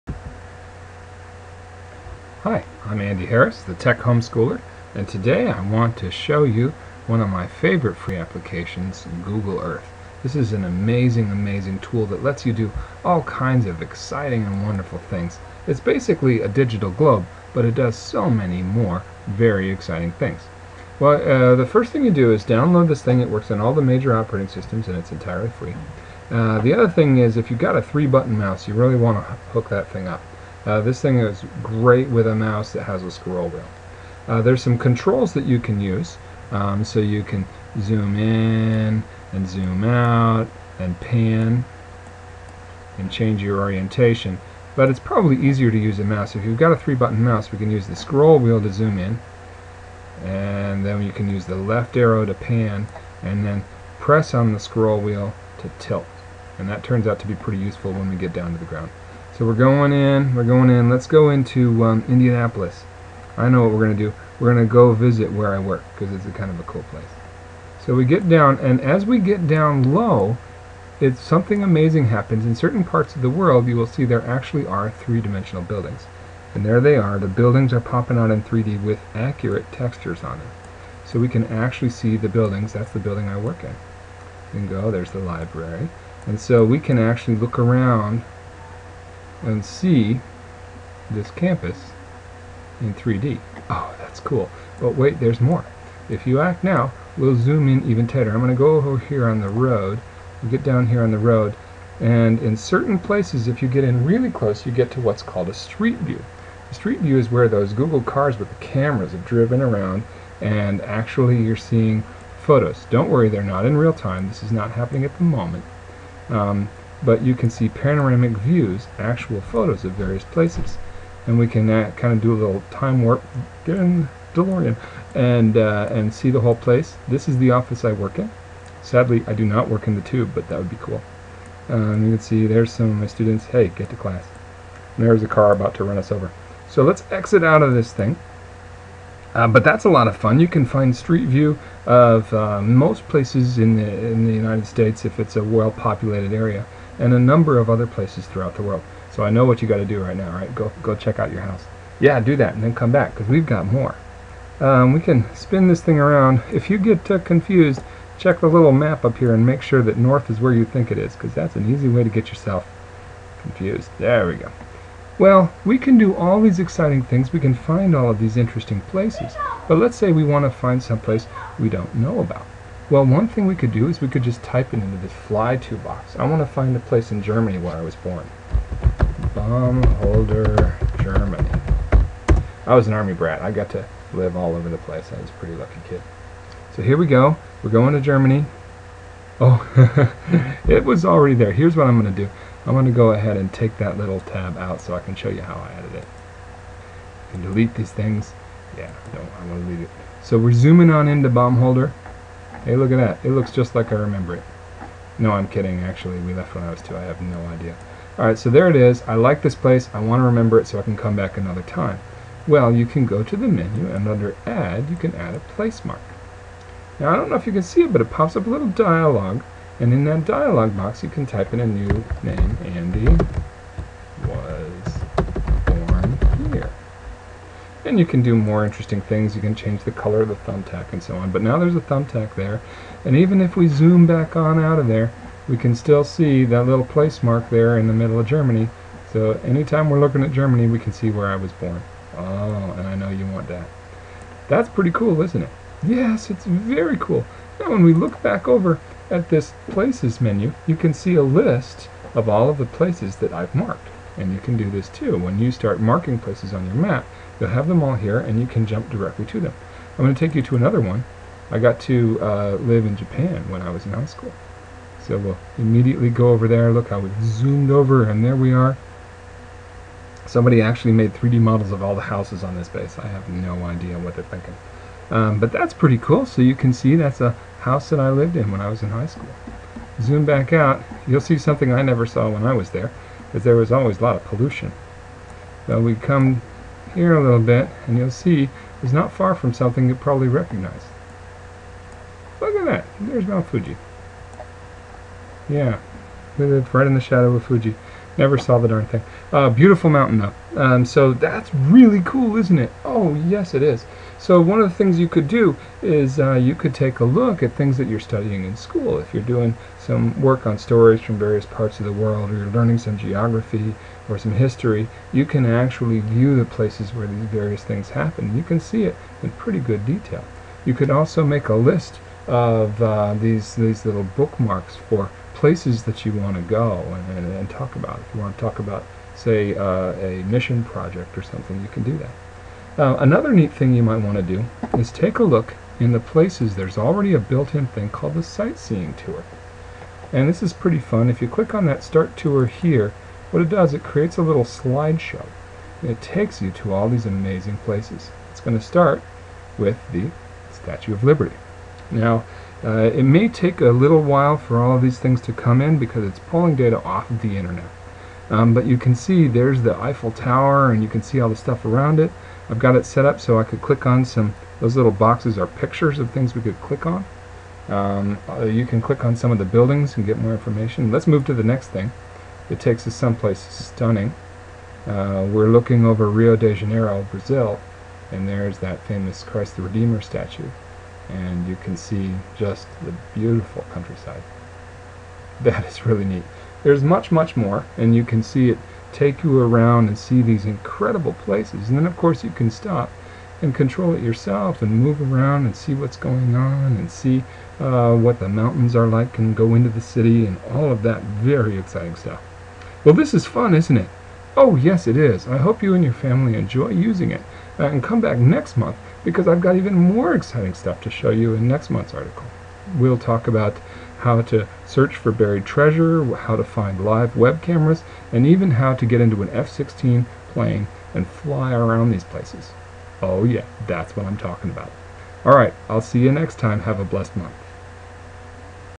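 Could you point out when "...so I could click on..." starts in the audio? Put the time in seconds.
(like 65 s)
363 s.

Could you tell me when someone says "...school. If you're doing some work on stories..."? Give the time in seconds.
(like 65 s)
308 s.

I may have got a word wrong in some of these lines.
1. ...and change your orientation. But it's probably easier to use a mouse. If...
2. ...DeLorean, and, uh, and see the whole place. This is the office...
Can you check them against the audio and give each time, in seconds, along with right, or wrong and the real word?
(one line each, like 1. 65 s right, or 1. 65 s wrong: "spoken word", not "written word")
1. 42 s right
2. 124 s right.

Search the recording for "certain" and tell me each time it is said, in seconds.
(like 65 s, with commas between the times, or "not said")
72 s, 102 s.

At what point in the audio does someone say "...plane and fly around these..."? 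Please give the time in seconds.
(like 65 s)
420 s.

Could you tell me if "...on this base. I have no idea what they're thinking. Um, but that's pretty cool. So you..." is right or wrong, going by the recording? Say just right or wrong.
right.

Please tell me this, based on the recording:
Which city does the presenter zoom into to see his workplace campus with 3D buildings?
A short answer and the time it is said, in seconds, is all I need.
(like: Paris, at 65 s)
Indianapolis, at 62 s.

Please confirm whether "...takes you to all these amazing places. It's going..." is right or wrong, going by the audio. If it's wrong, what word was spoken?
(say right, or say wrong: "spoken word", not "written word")
right.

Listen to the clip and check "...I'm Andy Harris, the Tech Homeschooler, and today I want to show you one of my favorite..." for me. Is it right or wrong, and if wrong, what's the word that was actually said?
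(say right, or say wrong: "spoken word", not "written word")
right.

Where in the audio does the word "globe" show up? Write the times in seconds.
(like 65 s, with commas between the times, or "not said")
16 s.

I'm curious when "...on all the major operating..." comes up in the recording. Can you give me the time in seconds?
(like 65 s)
23 s.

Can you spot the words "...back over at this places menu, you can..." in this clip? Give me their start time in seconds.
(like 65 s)
248 s.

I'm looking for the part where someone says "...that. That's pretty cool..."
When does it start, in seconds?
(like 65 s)
243 s.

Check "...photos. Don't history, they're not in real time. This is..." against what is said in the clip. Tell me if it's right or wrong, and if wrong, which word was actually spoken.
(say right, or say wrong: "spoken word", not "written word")
wrong: "worry", not "history".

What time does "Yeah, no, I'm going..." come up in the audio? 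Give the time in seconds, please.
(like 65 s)
198 s.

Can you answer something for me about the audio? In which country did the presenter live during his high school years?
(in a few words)
Japan.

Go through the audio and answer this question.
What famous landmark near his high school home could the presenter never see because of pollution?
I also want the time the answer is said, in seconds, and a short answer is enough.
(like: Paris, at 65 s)
Mount Fuji, at 293 s.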